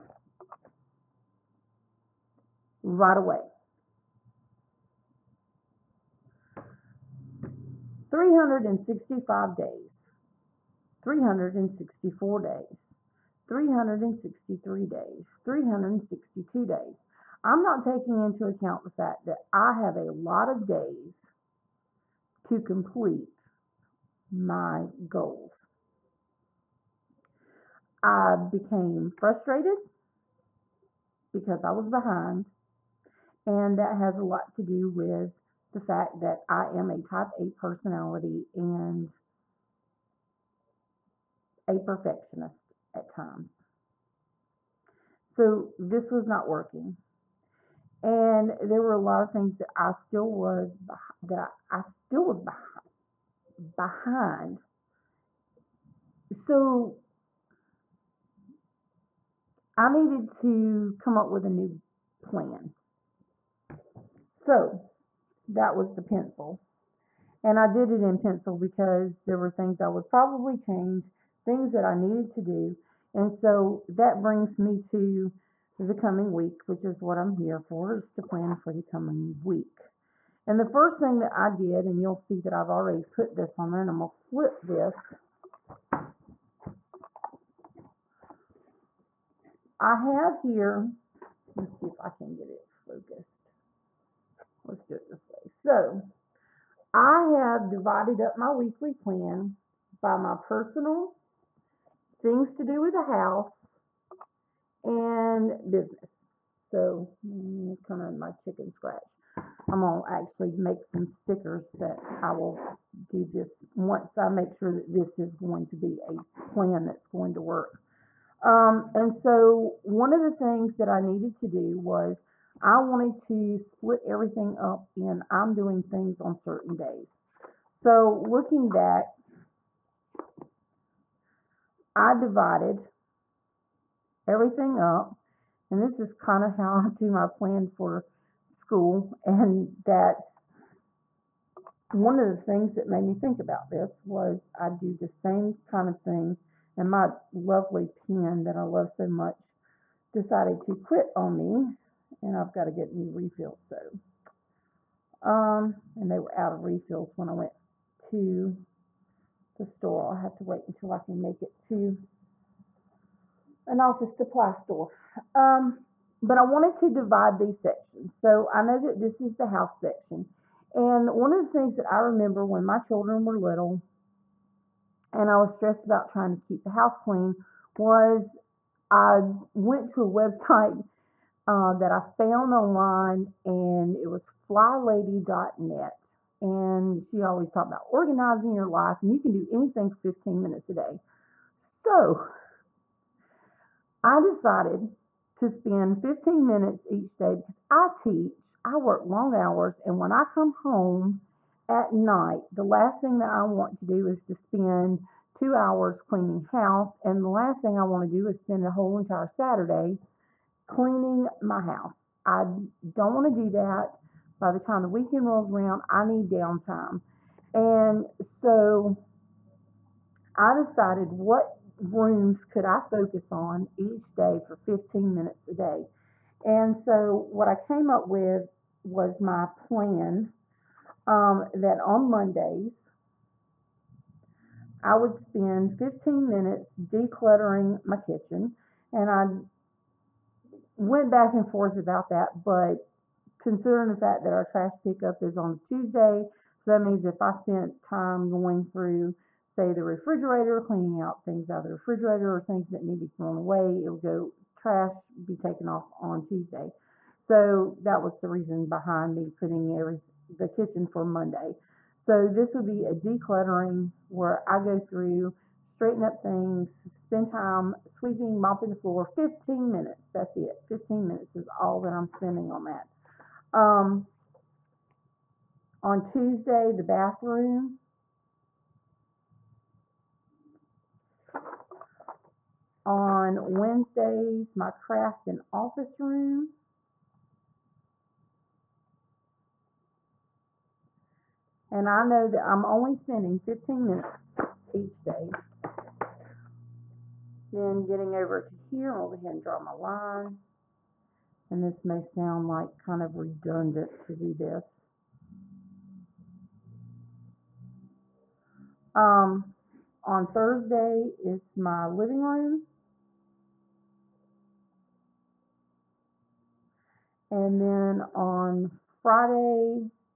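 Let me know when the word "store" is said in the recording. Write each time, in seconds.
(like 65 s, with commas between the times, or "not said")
159 s, 164 s.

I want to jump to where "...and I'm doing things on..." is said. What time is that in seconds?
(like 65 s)
124 s.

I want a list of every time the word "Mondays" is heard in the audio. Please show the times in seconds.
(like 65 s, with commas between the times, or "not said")
232 s, 261 s.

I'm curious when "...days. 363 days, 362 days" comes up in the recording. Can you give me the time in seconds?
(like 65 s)
12 s.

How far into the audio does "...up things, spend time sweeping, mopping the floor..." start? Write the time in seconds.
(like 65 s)
266 s.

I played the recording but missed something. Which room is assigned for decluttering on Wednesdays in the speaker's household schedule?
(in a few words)
craft and office room.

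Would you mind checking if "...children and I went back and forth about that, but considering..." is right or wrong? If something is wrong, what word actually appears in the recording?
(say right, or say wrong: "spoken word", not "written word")
wrong: "kitchen", not "children".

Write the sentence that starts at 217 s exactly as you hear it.
And so I decided what rooms could I focus on each day for 15 minutes a day.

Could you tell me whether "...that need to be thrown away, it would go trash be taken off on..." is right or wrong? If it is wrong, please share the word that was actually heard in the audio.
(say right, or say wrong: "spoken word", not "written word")
right.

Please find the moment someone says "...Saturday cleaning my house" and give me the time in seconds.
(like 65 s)
209 s.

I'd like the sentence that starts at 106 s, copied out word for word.
So mm, kind of my chicken scratch.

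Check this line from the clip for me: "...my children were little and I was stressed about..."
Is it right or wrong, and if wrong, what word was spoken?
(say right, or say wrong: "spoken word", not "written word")
right.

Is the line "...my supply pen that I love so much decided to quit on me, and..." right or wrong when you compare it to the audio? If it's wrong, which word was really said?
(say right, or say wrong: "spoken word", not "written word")
wrong: "lovely", not "supply".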